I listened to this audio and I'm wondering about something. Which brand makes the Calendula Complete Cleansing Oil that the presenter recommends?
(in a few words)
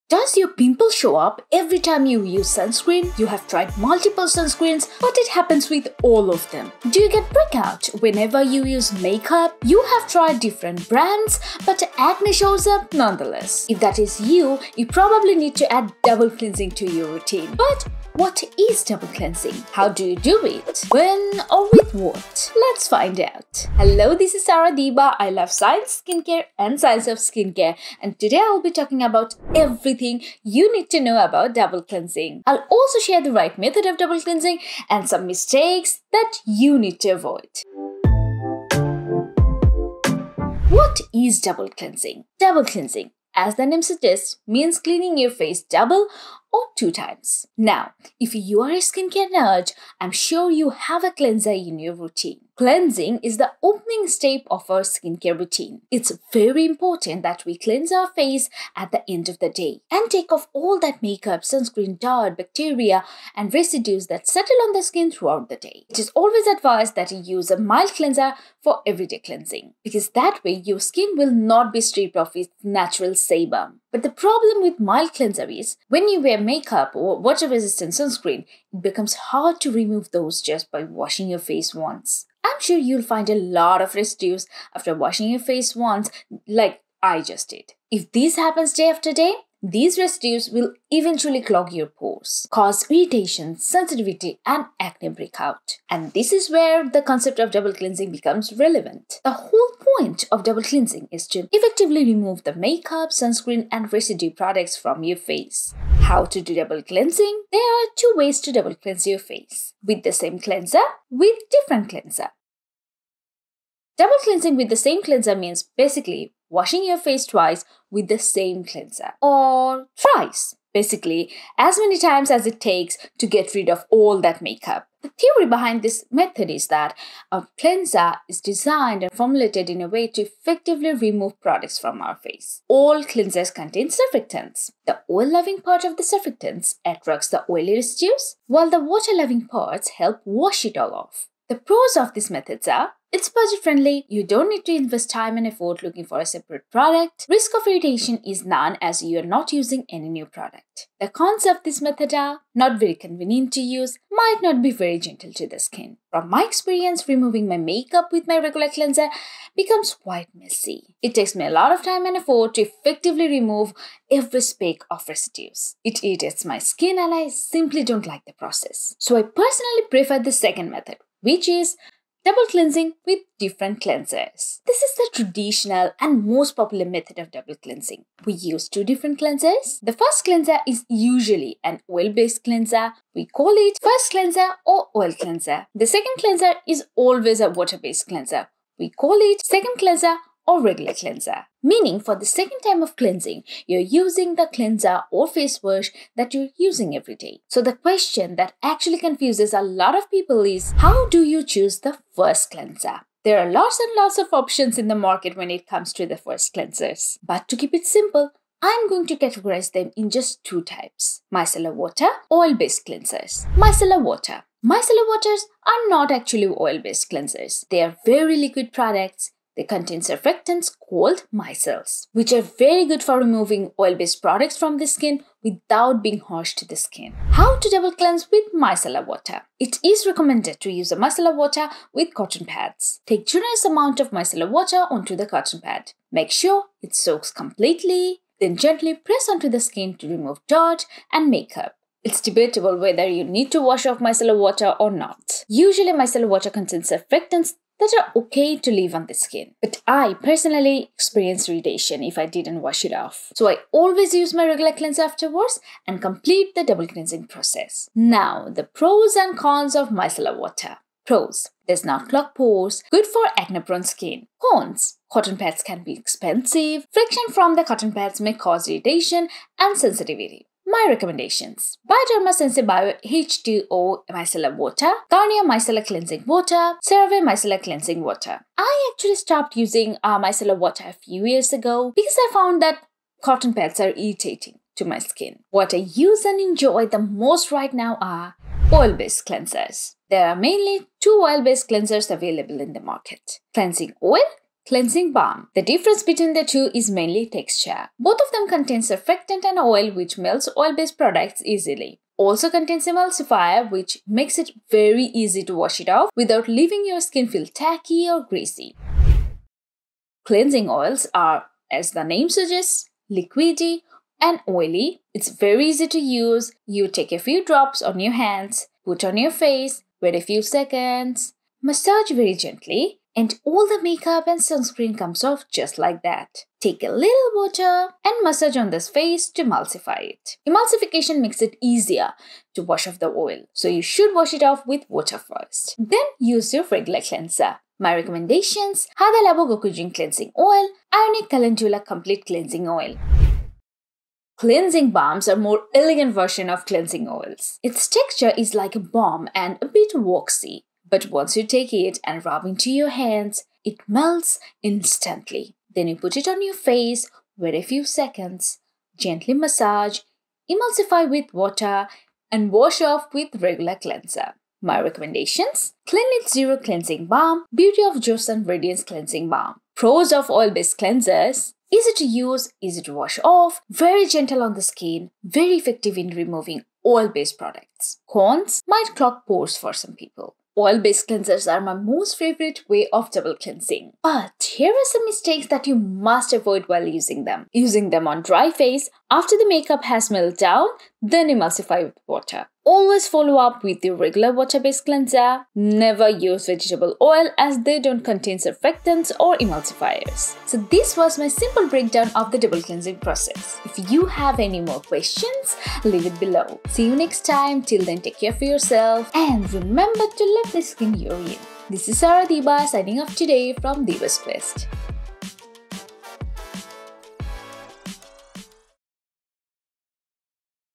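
Iunik.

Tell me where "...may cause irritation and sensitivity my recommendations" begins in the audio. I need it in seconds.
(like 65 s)
268 s.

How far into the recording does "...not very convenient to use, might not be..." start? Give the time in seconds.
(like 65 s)
152 s.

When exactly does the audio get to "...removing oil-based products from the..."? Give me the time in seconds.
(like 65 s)
223 s.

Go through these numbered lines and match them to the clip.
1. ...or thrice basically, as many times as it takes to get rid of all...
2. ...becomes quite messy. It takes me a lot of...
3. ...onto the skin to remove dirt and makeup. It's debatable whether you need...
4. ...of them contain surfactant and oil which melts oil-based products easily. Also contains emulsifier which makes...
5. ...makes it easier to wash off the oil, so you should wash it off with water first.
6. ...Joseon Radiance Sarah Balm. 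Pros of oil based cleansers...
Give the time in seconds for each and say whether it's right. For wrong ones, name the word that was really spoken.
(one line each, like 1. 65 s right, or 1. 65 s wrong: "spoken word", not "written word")
1. 119 s right
2. 159 s right
3. 239 s right
4. 298 s right
5. 331 s right
6. 367 s wrong: "Cleansing", not "Sarah".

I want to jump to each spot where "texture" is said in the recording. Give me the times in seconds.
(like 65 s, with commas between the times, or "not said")
297 s, 347 s.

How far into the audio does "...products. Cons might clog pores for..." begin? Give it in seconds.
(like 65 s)
377 s.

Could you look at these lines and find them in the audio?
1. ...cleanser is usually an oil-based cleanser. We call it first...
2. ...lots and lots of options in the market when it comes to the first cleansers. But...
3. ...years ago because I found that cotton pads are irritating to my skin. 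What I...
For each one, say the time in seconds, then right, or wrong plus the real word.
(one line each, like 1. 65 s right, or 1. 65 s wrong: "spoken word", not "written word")
1. 180 s right
2. 203 s right
3. 281 s right.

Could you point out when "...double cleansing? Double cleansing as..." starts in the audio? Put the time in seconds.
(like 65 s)
41 s.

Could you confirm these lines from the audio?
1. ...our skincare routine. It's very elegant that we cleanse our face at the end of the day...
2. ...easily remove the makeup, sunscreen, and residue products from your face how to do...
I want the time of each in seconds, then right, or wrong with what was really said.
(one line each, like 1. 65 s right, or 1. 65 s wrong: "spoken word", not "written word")
1. 54 s wrong: "important", not "elegant"
2. 101 s wrong: "effectively", not "easily".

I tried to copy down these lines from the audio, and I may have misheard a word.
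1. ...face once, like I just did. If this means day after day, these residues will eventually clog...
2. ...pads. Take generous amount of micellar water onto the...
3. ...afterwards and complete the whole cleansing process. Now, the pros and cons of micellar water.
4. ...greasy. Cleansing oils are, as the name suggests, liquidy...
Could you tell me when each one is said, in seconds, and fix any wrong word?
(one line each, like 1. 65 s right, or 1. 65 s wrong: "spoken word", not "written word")
1. 85 s wrong: "happens", not "means"
2. 232 s right
3. 255 s wrong: "double", not "whole"
4. 308 s right.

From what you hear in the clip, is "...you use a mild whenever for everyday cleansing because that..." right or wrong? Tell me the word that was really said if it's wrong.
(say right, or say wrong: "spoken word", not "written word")
wrong: "cleanser", not "whenever".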